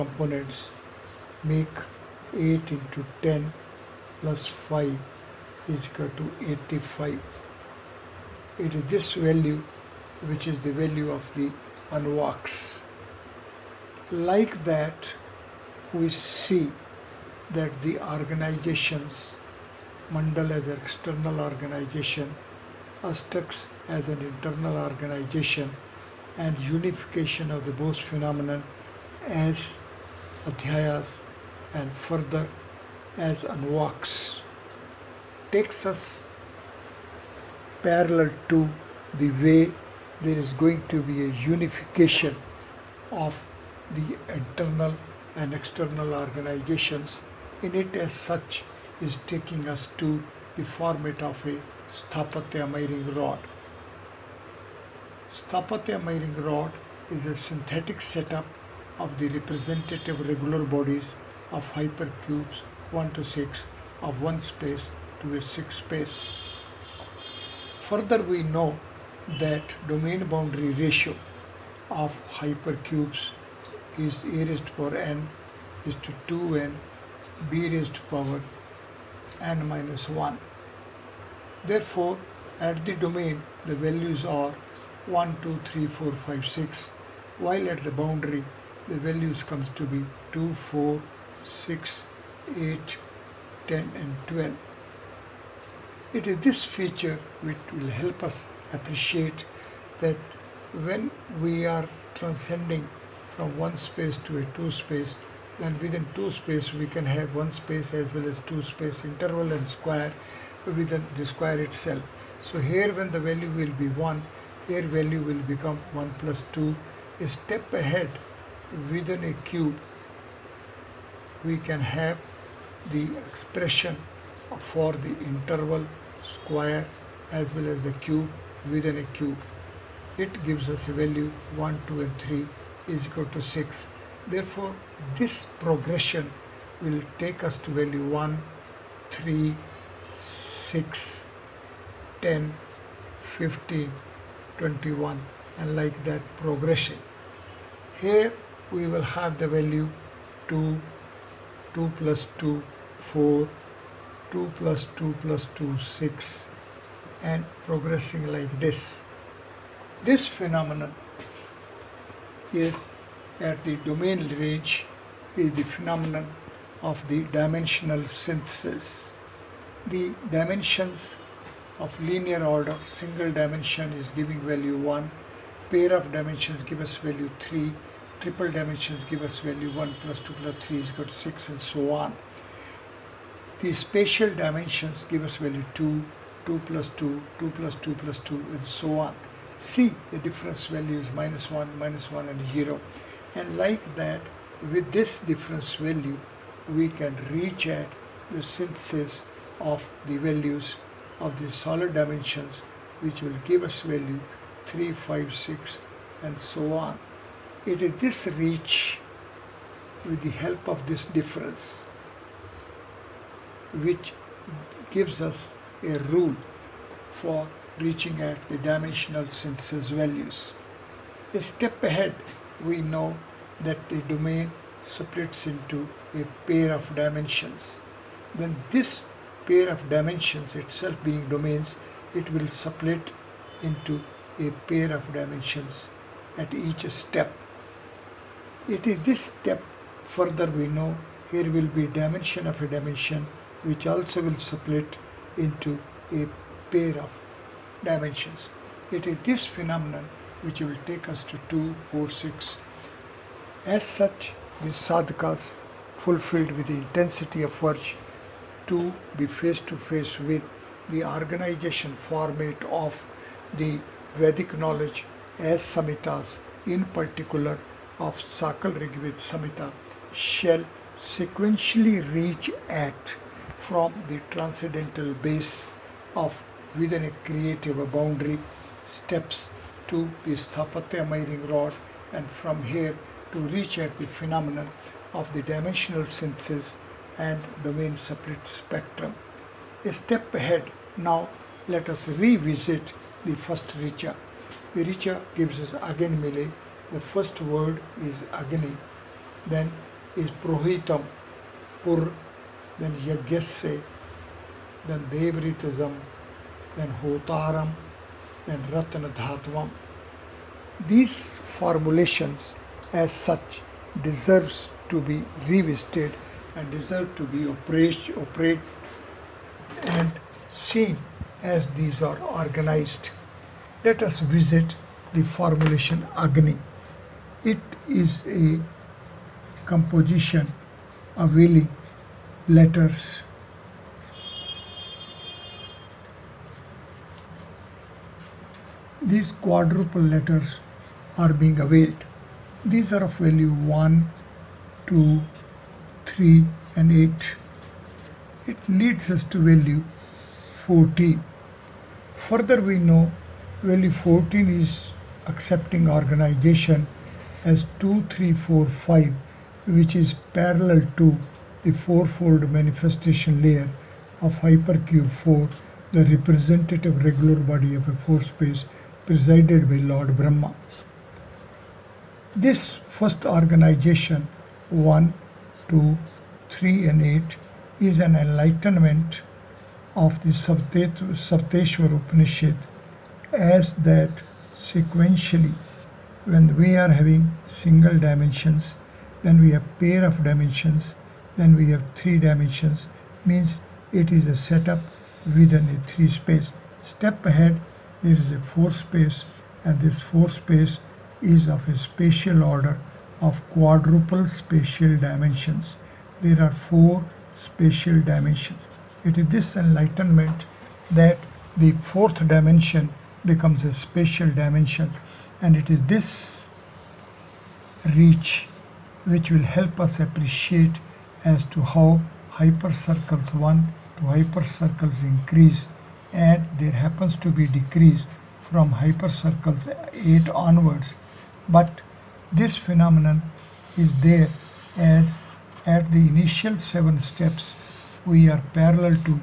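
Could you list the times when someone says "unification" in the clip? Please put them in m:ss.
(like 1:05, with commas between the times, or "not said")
0:26, 0:41.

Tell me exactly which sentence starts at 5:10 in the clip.
These formulations as such deserves to be revisited and deserve to be operated, operate and seen as these are organized.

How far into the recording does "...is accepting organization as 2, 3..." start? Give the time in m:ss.
5:54.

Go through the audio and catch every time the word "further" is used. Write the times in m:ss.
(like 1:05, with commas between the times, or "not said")
0:31, 1:07, 4:00, 5:52.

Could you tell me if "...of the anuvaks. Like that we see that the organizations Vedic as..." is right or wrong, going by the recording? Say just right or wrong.
wrong.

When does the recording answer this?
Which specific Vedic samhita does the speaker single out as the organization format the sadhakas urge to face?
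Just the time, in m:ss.
4:28.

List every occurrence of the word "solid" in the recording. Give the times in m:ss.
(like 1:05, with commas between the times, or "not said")
3:21.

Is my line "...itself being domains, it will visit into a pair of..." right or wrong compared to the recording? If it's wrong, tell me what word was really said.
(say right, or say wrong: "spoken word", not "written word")
wrong: "split", not "visit".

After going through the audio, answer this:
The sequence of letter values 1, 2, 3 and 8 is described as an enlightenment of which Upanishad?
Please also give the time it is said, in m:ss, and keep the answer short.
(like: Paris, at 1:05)
Sapteshwar Upanishad, at 6:20.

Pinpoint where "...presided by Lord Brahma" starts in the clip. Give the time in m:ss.
6:09.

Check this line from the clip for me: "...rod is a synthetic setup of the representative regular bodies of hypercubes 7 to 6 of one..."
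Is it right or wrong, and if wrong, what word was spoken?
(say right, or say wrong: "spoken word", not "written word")
wrong: "1", not "7".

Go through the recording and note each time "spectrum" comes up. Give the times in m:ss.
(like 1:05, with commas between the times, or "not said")
4:48.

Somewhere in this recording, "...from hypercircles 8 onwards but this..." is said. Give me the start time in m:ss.
7:08.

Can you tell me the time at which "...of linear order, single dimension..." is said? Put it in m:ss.
2:51.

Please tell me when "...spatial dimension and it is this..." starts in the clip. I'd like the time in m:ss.
6:53.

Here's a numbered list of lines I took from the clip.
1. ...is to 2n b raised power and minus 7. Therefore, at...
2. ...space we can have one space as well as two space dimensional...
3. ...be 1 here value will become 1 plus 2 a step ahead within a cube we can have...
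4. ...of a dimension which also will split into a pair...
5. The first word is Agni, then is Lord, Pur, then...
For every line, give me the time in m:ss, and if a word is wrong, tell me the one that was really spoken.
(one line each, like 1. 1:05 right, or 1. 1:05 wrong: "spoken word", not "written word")
1. 1:15 wrong: "1", not "7"
2. 1:46 wrong: "interval", not "dimensional"
3. 1:53 right
4. 4:02 right
5. 4:56 wrong: "Prohitam", not "Lord".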